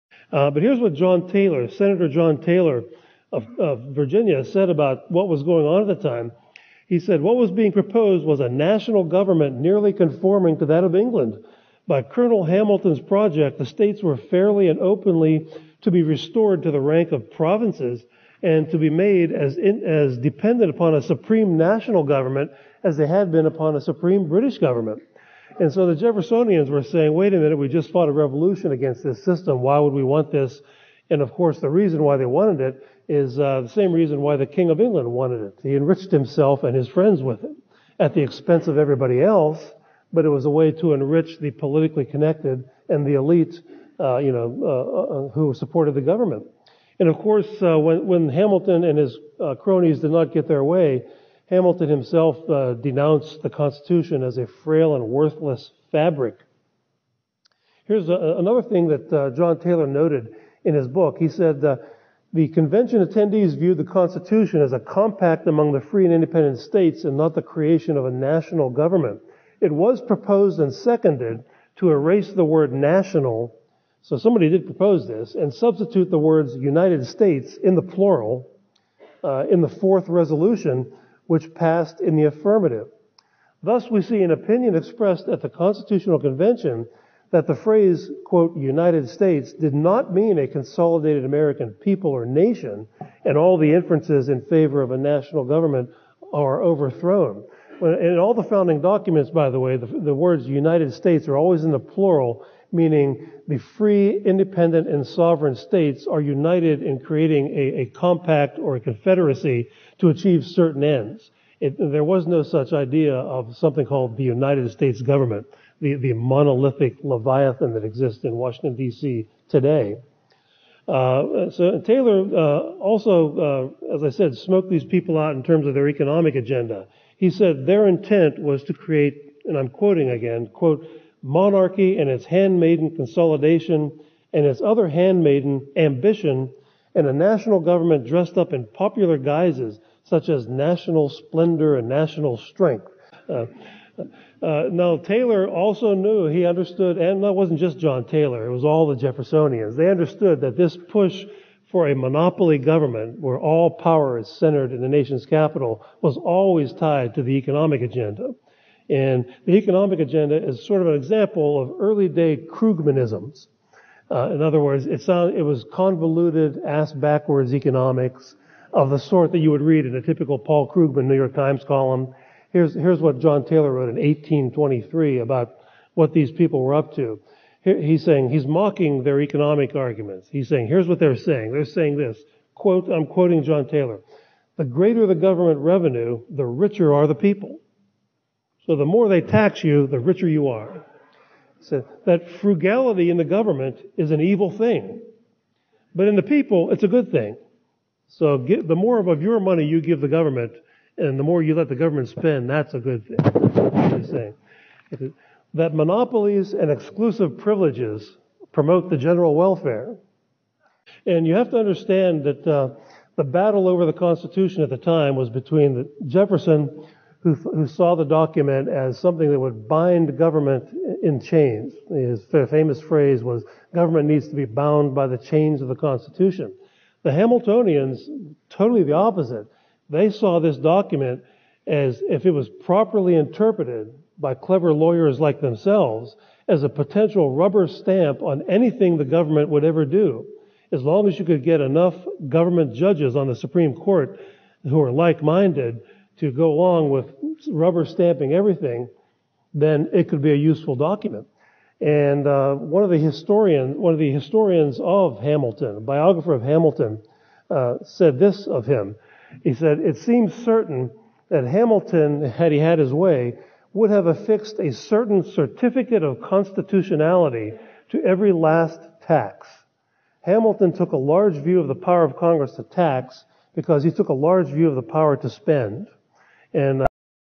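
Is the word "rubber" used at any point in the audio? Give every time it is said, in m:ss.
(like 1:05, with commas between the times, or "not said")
3:57, 4:07.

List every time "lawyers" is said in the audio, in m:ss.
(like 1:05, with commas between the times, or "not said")
3:54.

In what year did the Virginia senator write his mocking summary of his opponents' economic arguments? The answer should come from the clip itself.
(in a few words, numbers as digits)
1823.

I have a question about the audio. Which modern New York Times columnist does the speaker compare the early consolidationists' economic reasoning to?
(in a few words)
Paul Krugman.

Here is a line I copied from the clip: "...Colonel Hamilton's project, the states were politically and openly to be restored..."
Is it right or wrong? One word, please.
wrong.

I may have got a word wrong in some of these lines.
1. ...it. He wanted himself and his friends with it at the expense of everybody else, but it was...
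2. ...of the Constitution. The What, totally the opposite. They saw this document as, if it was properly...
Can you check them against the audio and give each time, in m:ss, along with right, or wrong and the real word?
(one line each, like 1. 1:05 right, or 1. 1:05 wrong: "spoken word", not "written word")
1. 0:35 wrong: "enriched", not "wanted"
2. 3:45 wrong: "Hamiltonians", not "What".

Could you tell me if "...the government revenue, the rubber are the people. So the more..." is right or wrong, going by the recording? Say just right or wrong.
wrong.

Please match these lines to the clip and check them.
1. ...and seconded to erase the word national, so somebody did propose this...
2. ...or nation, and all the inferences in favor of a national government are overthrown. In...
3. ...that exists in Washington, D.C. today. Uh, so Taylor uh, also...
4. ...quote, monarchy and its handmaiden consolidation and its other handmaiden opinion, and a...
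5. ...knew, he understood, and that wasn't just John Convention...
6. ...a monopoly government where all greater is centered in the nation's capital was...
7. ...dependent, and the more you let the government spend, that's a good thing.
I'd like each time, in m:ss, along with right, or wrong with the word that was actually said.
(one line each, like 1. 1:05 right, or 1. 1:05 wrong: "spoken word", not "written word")
1. 1:10 right
2. 1:32 right
3. 1:57 right
4. 2:10 wrong: "ambition", not "opinion"
5. 2:25 wrong: "Taylor", not "Convention"
6. 2:31 wrong: "power", not "greater"
7. 3:20 wrong: "government", not "dependent".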